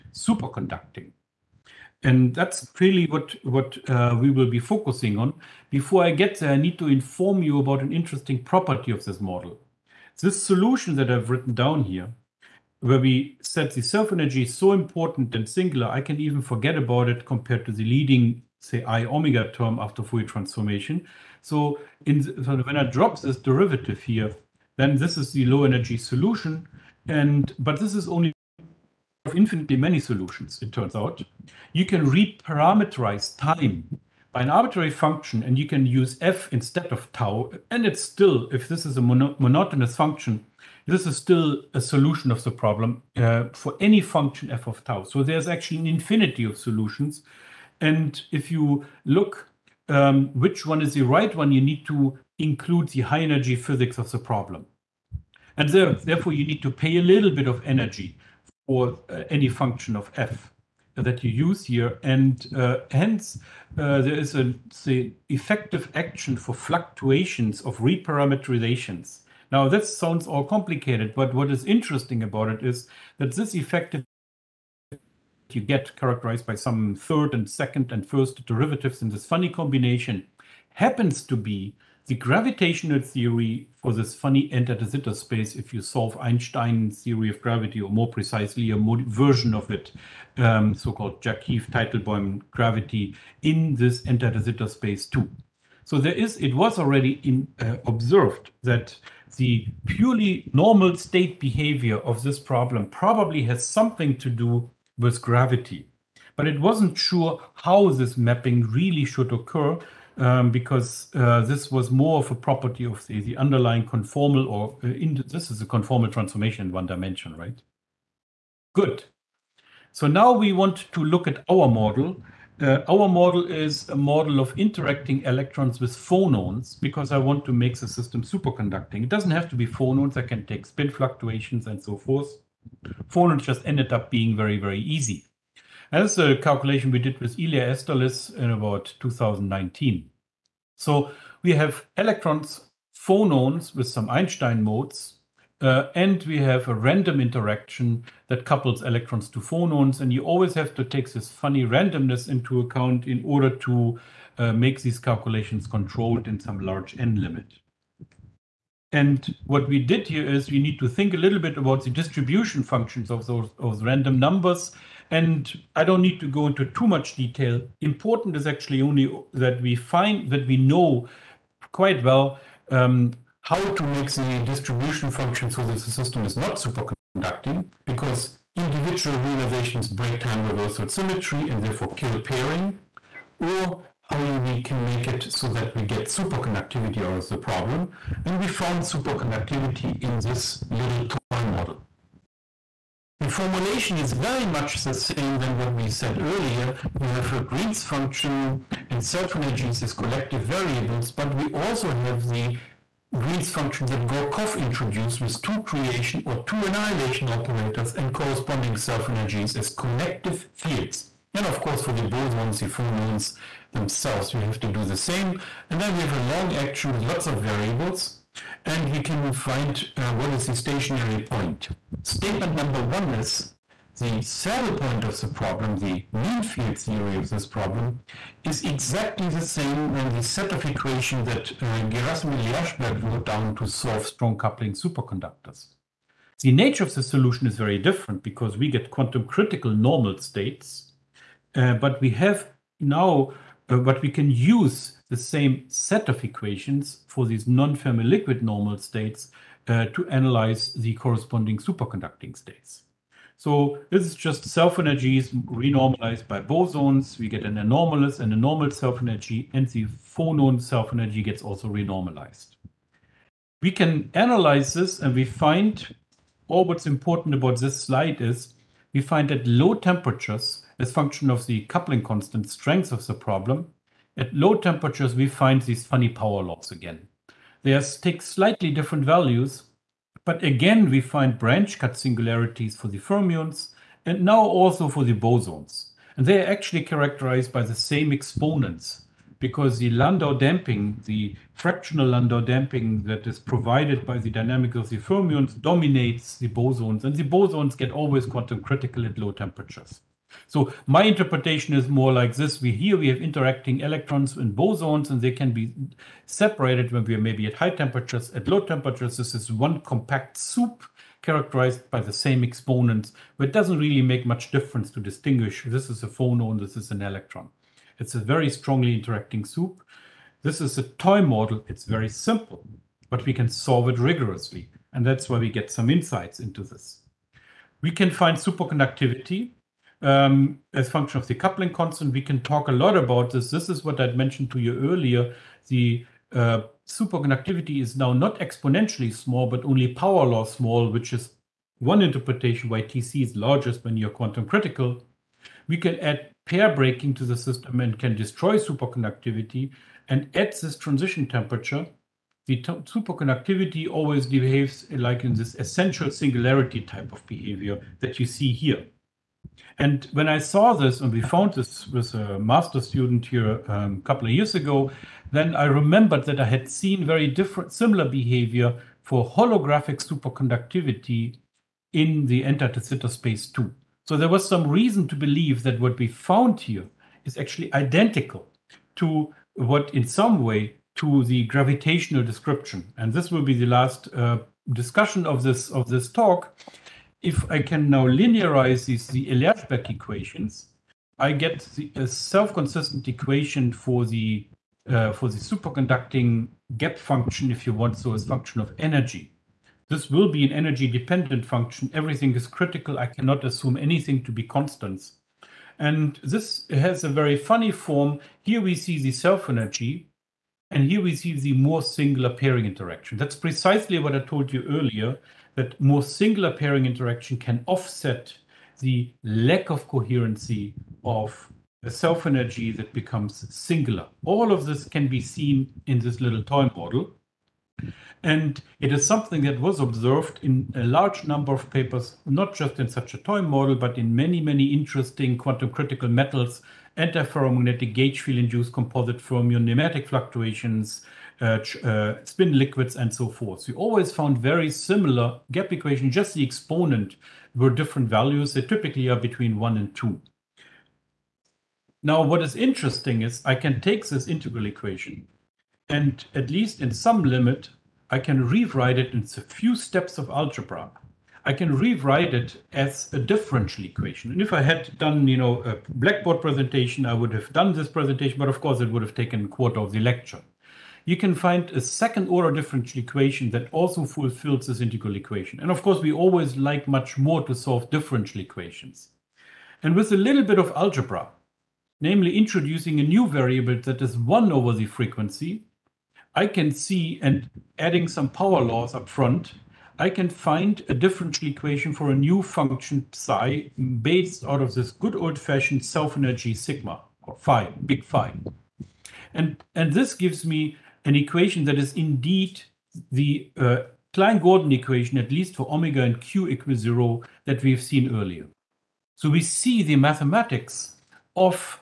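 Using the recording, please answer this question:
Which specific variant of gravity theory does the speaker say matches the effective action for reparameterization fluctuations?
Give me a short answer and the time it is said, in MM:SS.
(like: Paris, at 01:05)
Jackiw-Teitelboim gravity, at 01:31.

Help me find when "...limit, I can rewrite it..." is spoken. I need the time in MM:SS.
07:37.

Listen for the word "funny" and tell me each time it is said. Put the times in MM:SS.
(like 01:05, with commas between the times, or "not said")
01:19, 01:24, 02:31, 04:35, 06:47.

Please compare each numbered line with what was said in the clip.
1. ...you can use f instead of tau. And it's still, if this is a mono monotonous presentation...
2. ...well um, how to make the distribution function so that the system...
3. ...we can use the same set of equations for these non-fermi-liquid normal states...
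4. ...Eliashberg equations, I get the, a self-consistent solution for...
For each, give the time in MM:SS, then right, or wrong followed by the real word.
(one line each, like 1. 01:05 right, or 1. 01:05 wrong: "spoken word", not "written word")
1. 00:35 wrong: "function", not "presentation"
2. 02:52 right
3. 04:04 right
4. 06:29 wrong: "equation", not "solution".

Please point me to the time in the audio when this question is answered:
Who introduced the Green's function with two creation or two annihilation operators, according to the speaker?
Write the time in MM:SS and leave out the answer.
03:24.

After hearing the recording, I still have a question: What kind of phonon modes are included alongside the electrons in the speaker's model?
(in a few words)
Einstein modes.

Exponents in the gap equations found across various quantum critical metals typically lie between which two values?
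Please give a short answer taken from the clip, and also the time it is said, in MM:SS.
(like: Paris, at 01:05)
1 and 2, at 07:29.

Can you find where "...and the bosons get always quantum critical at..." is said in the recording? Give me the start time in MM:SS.
04:57.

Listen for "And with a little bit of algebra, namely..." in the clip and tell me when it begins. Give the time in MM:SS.
07:59.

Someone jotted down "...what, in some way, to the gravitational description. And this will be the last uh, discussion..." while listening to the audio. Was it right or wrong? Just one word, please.
right.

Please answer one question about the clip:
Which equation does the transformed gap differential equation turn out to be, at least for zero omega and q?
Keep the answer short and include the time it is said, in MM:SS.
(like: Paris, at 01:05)
Klein-Gordon equation, at 08:24.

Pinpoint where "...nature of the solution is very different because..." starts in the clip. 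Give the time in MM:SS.
03:56.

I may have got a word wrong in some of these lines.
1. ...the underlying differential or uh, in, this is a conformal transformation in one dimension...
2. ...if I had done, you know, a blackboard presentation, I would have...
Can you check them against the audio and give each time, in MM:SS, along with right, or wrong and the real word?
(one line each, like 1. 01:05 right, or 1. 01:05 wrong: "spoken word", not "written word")
1. 01:53 wrong: "conformal", not "differential"
2. 07:44 right.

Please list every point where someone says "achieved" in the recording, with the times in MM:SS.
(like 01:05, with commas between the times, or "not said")
not said.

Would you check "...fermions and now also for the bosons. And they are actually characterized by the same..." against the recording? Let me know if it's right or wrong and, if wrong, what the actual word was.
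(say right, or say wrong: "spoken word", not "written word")
right.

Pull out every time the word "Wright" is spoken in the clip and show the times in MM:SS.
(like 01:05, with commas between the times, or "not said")
not said.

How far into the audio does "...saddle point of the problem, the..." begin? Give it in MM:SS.
03:44.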